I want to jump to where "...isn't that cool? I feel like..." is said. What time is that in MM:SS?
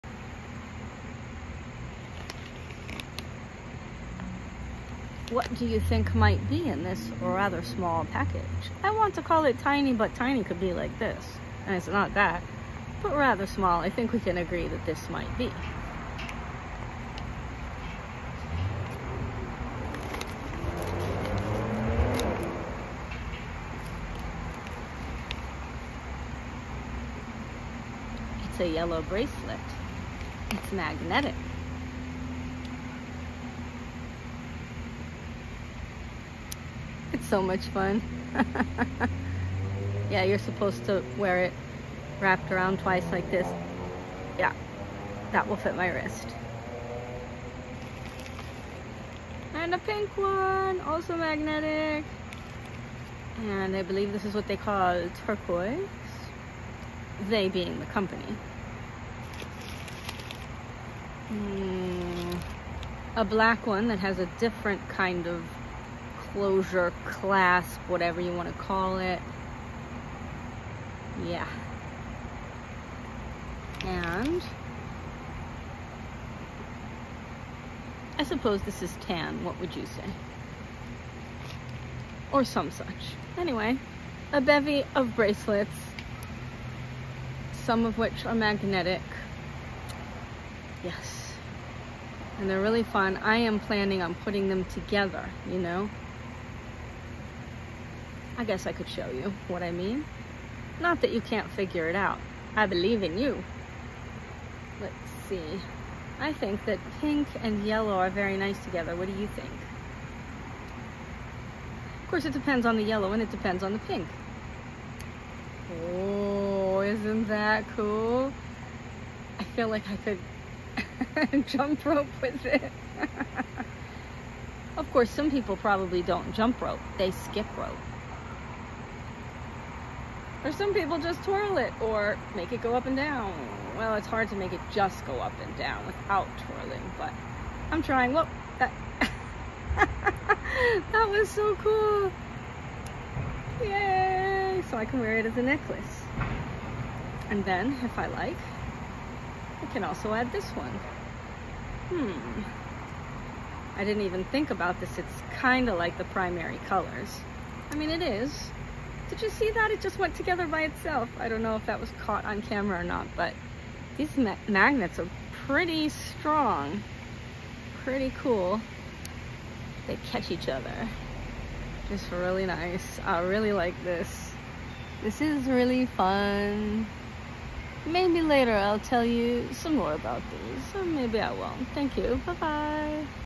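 01:56.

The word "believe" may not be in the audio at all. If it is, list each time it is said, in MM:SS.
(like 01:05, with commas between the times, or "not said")
00:53, 01:42.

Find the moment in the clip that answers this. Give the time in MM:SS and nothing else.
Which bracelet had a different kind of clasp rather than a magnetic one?
01:03.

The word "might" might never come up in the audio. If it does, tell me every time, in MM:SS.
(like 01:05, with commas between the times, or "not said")
00:06, 00:15.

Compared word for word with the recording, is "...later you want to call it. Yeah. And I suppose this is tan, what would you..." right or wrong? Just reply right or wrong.
wrong.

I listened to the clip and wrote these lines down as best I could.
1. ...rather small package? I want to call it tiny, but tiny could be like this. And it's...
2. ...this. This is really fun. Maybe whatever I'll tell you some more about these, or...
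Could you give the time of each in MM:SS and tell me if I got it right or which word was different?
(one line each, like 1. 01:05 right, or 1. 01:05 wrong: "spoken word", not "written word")
1. 00:07 right
2. 02:53 wrong: "later", not "whatever".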